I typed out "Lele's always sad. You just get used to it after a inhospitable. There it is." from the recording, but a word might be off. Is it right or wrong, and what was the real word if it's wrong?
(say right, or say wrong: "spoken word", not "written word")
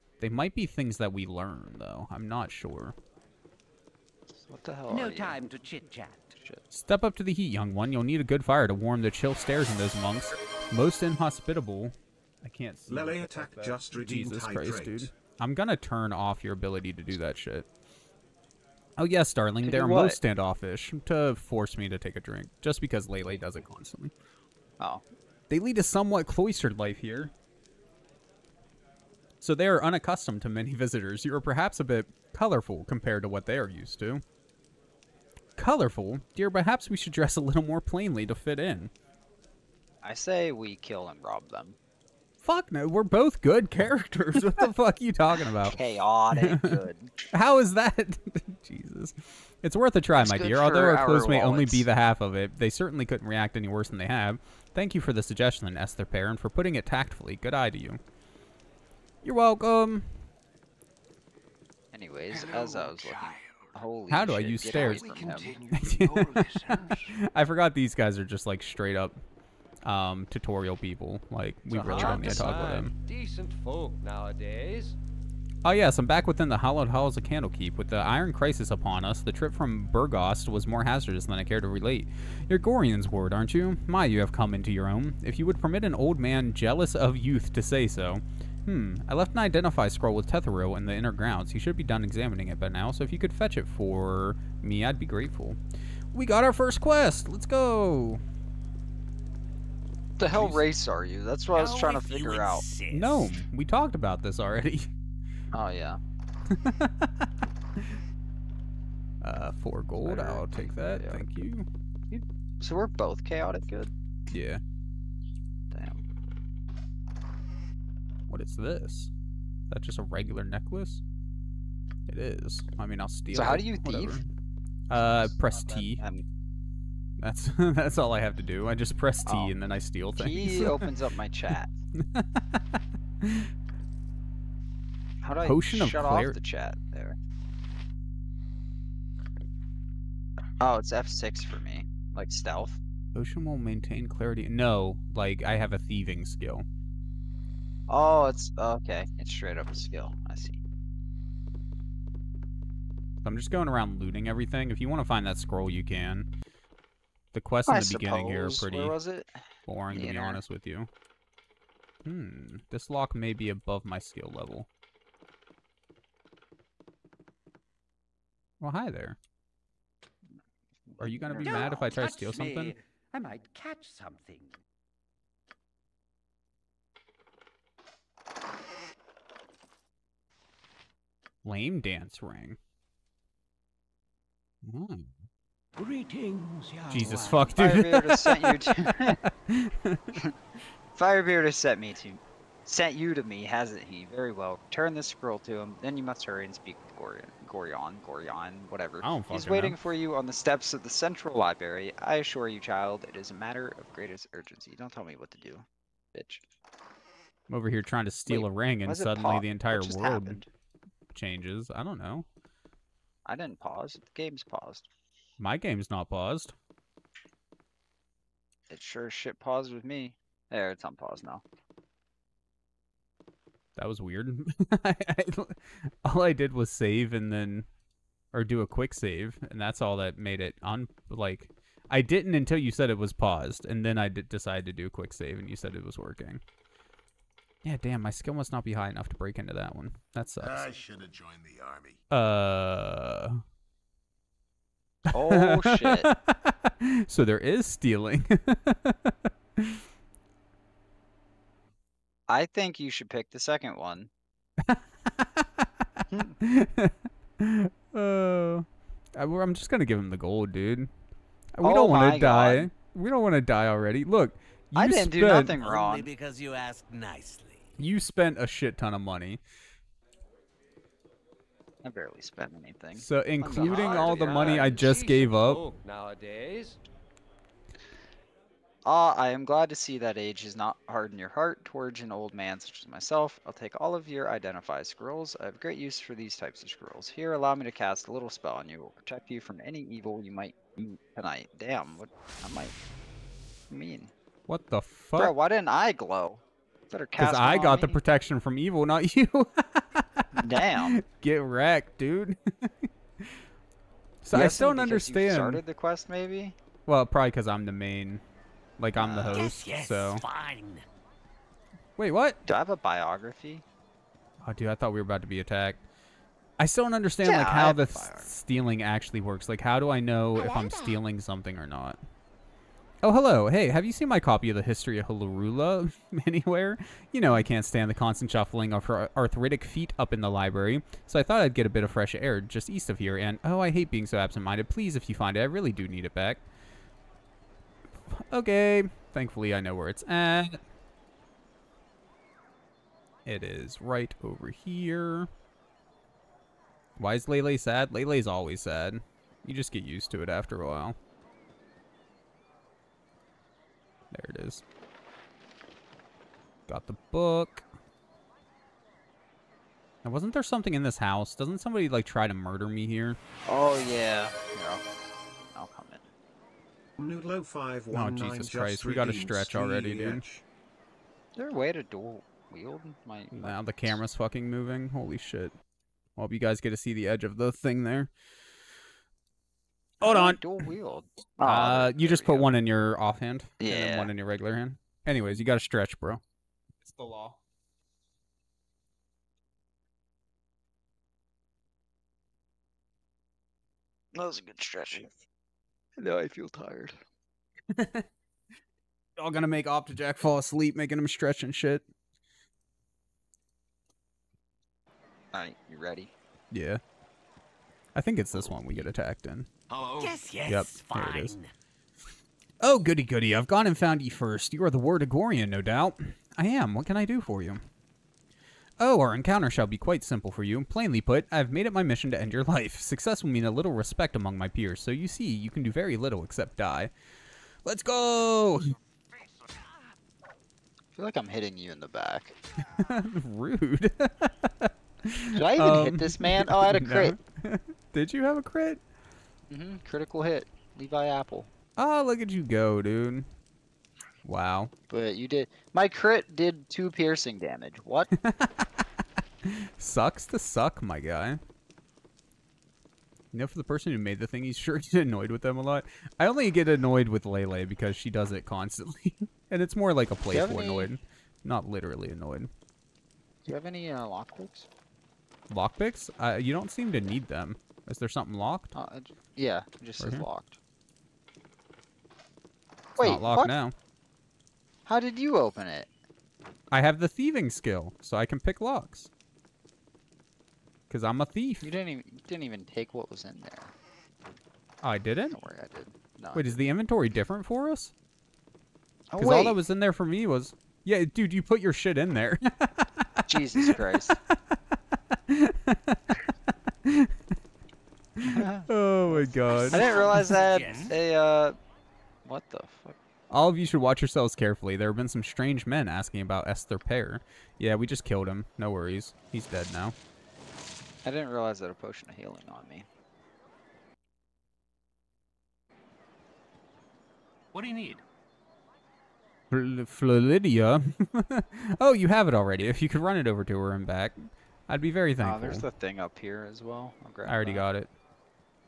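wrong: "while", not "inhospitable".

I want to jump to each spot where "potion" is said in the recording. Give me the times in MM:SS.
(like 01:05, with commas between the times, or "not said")
02:15, 02:23, 08:31.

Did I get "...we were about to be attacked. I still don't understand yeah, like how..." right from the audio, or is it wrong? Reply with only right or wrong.
right.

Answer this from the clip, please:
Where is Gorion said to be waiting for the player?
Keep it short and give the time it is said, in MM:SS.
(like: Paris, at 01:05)
steps of the central library, at 03:20.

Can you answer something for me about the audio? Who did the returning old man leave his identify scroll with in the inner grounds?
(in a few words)
Tetheril.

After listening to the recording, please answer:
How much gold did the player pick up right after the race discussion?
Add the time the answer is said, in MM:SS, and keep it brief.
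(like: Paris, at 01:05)
4 gold, at 01:49.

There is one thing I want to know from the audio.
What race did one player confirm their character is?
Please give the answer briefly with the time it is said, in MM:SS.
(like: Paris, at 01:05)
Gnome, at 01:43.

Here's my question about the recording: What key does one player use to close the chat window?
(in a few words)
F6.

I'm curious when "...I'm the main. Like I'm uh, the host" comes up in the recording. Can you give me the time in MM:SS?
05:07.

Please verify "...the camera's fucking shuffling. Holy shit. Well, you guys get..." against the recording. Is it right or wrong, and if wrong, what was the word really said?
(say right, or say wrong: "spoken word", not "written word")
wrong: "moving", not "shuffling".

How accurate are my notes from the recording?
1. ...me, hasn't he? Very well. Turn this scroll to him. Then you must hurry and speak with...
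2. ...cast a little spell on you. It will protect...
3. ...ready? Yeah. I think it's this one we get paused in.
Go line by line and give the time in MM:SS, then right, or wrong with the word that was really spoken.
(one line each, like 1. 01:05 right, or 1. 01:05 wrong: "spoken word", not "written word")
1. 03:13 right
2. 04:47 right
3. 06:45 wrong: "attacked", not "paused".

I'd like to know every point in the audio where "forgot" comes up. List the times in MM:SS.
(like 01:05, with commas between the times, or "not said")
01:07.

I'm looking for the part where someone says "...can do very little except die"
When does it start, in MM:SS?
07:05.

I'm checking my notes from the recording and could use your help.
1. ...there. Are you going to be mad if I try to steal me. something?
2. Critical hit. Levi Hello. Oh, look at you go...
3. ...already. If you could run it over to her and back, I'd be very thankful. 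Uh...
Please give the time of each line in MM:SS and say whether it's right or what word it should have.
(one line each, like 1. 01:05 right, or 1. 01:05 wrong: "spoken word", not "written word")
1. 02:48 right
2. 07:19 wrong: "Apple", not "Hello"
3. 08:42 right.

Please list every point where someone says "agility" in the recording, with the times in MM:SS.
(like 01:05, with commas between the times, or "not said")
not said.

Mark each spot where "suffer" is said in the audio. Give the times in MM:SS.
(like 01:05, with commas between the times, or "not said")
not said.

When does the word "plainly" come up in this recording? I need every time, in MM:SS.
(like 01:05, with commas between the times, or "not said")
00:37, 07:00.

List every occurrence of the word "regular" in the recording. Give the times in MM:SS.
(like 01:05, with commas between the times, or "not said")
02:00, 06:24.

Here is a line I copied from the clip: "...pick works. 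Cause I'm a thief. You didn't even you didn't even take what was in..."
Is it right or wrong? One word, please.
wrong.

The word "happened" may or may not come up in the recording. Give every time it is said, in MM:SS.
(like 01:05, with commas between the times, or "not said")
03:30.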